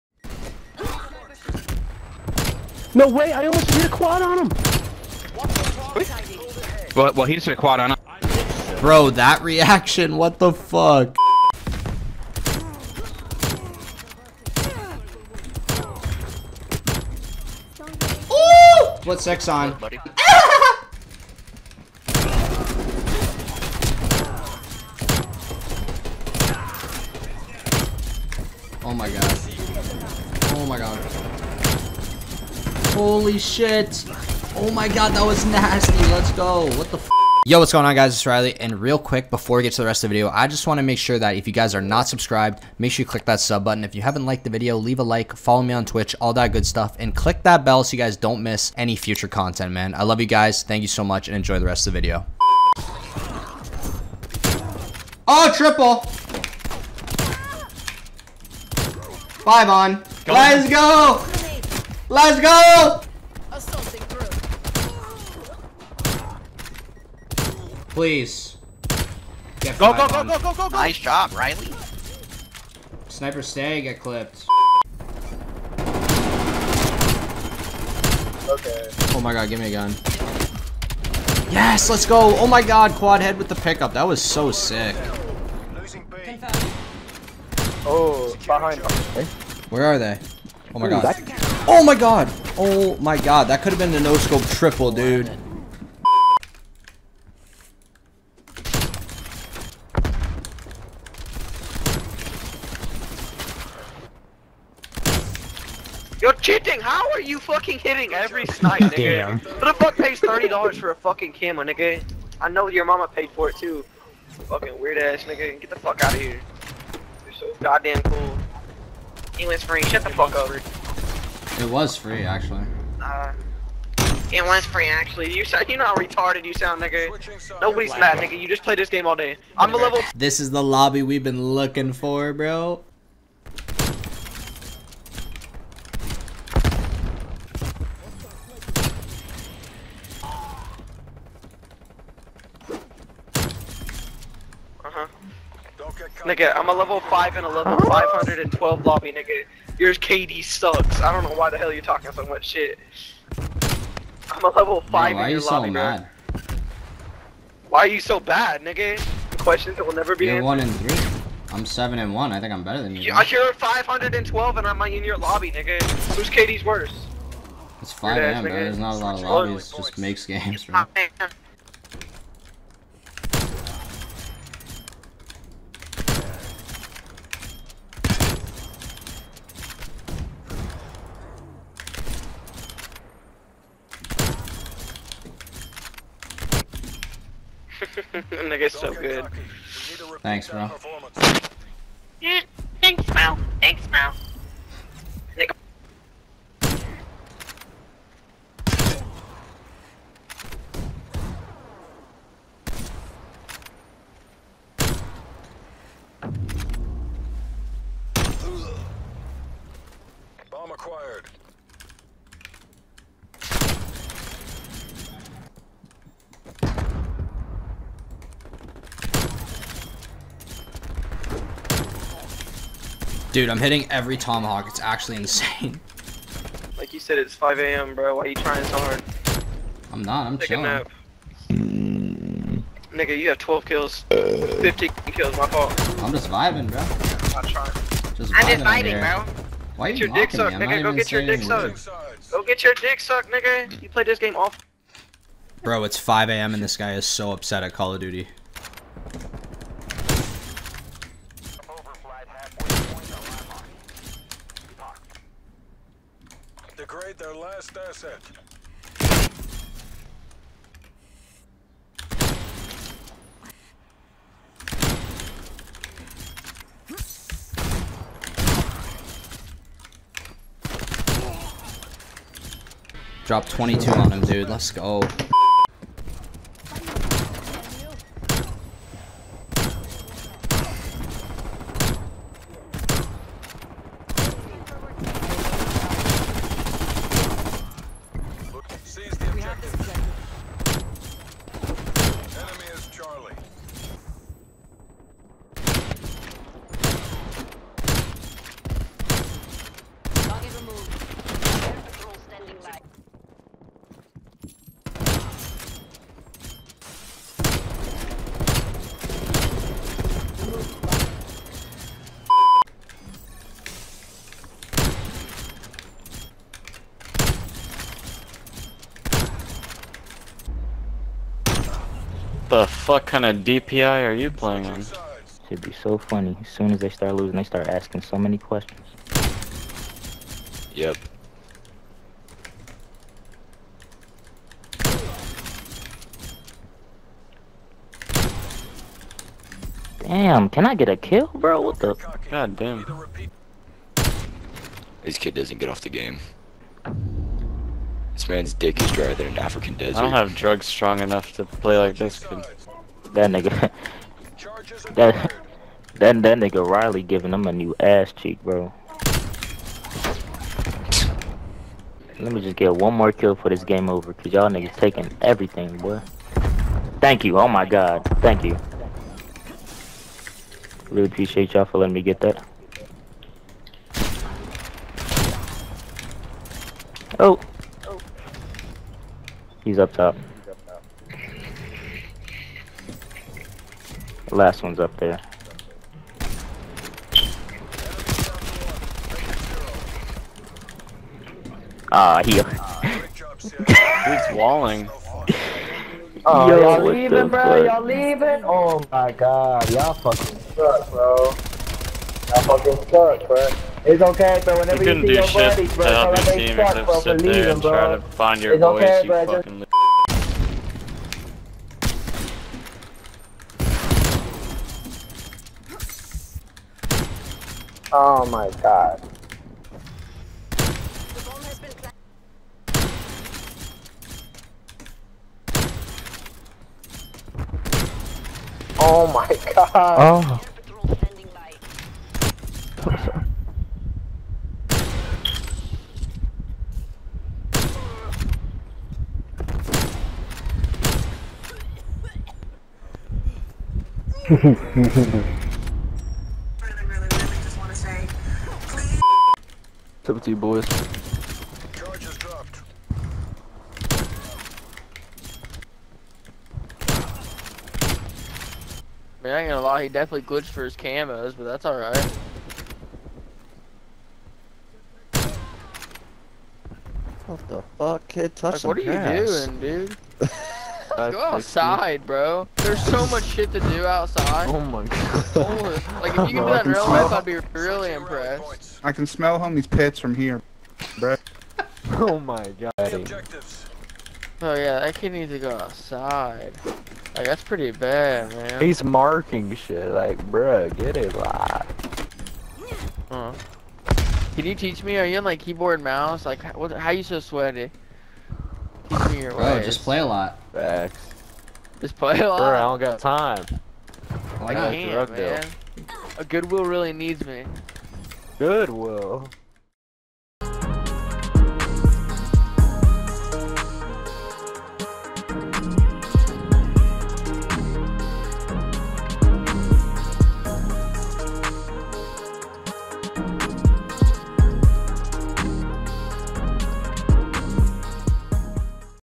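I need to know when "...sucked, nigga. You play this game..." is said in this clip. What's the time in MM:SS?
04:02.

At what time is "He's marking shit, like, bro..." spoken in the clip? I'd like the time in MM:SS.
08:08.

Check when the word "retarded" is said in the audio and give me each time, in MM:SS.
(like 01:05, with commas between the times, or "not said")
02:05.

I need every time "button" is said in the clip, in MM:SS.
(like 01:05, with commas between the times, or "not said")
00:43.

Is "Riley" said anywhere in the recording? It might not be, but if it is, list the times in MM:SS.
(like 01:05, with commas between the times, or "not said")
00:38, 01:11, 05:56.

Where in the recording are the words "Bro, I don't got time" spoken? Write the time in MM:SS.
08:22.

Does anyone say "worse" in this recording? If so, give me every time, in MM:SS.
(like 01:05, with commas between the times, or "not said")
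02:46.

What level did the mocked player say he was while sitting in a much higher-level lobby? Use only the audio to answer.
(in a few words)
512.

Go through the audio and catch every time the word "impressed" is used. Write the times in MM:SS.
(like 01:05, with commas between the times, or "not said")
07:57.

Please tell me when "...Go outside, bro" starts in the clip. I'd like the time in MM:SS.
07:50.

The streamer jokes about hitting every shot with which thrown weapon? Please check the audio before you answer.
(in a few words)
tomahawk.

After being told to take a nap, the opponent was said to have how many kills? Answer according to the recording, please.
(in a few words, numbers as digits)
12.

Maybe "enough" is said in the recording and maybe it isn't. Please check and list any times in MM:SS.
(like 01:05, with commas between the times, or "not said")
05:50.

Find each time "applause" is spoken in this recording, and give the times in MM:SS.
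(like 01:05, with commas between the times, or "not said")
not said.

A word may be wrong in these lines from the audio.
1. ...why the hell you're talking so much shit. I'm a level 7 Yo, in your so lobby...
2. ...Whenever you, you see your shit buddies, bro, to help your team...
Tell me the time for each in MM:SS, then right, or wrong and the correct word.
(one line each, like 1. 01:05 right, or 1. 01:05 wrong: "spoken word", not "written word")
1. 02:31 wrong: "5", not "7"
2. 06:44 right.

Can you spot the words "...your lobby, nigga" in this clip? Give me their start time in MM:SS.
02:45.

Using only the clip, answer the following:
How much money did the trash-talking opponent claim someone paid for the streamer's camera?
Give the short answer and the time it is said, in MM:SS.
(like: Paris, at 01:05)
$30, at 01:50.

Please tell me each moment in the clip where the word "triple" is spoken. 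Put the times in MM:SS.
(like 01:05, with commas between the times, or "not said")
00:55, 01:34.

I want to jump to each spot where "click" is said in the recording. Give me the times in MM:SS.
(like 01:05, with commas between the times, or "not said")
00:43, 00:47.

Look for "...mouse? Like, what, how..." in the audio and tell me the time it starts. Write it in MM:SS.
08:15.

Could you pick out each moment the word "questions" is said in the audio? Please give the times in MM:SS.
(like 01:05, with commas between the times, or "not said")
02:39, 05:28.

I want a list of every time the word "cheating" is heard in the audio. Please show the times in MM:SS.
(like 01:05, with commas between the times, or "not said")
01:46.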